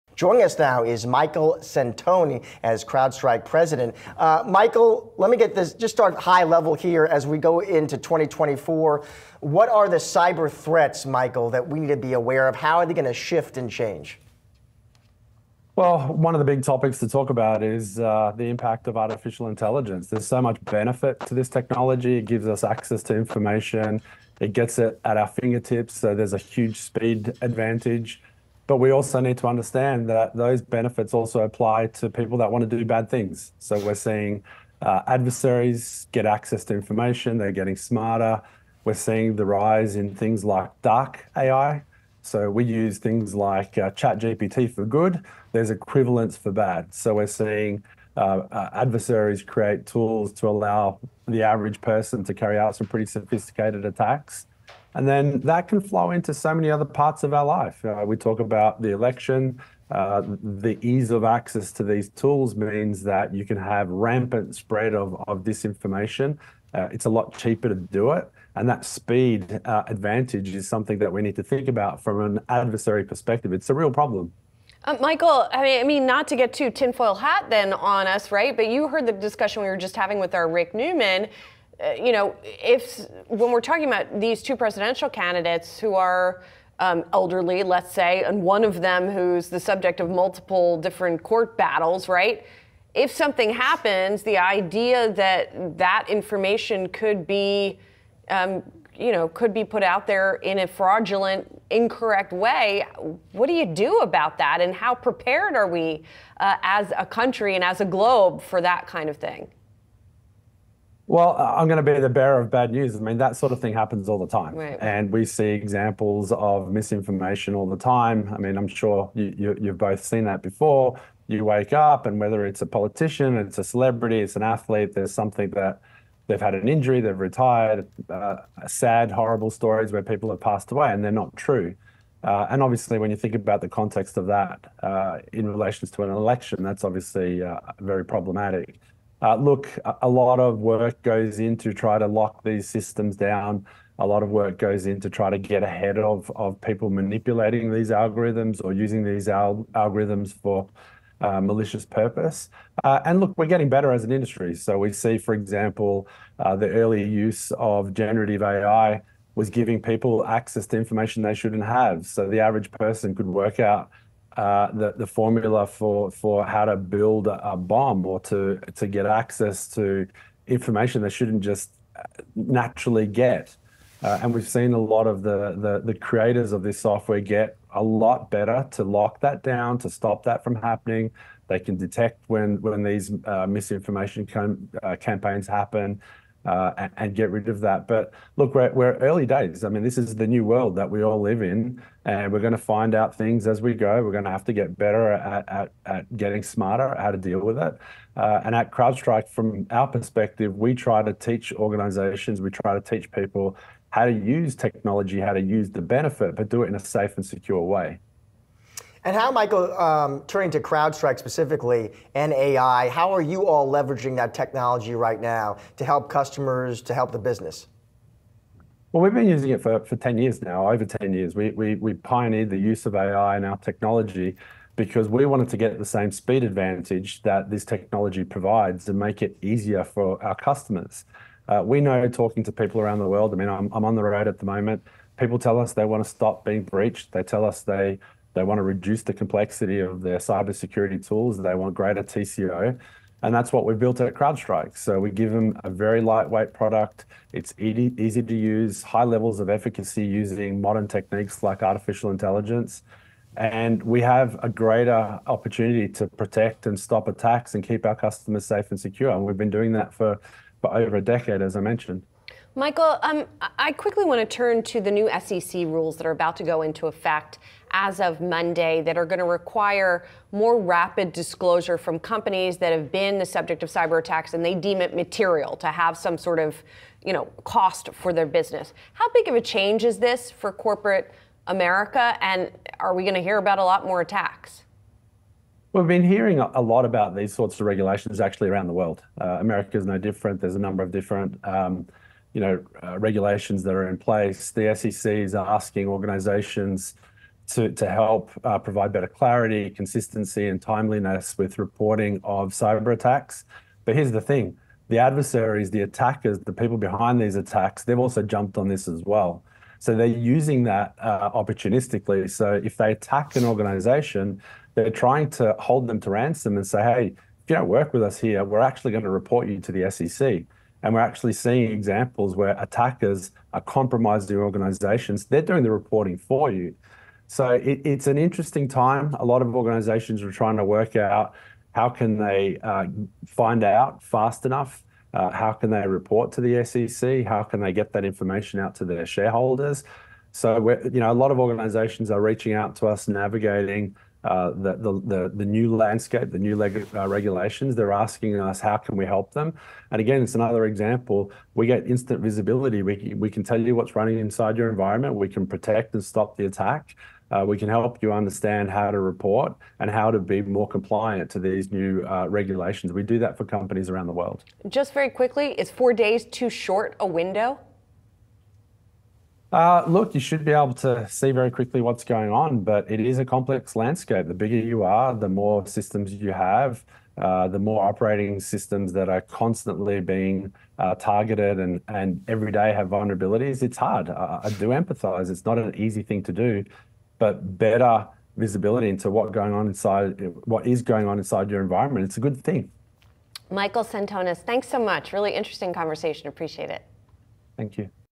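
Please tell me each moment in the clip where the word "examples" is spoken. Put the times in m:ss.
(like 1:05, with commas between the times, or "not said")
1:55, 2:35, 5:21, 5:50.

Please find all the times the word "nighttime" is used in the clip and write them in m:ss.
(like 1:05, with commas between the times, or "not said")
not said.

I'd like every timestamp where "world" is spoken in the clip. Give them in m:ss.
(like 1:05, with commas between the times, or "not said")
3:10, 3:53, 4:48, 6:04.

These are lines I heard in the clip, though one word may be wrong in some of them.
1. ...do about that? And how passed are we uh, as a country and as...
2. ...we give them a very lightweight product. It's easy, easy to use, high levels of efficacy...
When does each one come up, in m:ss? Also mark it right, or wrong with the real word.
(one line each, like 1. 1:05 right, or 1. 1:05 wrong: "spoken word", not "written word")
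1. 1:43 wrong: "prepared", not "passed"
2. 4:04 right.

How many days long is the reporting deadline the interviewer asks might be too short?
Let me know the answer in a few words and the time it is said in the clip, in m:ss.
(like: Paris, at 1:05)
4 days, at 6:05.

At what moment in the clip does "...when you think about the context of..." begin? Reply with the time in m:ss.
2:12.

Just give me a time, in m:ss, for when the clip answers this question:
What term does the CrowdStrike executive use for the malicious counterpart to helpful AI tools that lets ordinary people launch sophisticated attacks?
0:40.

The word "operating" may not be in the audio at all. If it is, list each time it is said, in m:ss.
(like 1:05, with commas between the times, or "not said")
6:17.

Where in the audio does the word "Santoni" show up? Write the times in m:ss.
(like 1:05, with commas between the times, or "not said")
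0:01.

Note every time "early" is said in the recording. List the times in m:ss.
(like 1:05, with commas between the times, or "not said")
2:36, 3:08.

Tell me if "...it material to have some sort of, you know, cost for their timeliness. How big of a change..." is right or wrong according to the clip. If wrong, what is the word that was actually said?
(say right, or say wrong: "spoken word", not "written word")
wrong: "business", not "timeliness".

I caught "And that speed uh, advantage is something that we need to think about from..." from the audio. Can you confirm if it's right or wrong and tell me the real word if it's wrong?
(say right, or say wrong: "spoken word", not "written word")
right.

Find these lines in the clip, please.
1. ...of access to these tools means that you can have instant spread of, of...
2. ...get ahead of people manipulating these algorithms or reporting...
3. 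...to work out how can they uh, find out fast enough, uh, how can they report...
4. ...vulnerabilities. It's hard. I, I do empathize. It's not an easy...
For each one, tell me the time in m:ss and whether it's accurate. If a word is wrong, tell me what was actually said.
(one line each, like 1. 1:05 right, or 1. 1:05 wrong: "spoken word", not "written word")
1. 1:01 wrong: "rampant", not "instant"
2. 2:25 wrong: "using", not "reporting"
3. 5:30 right
4. 6:22 right.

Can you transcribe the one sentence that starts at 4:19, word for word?
And we've been doing that for, for over a decade, as I mentioned.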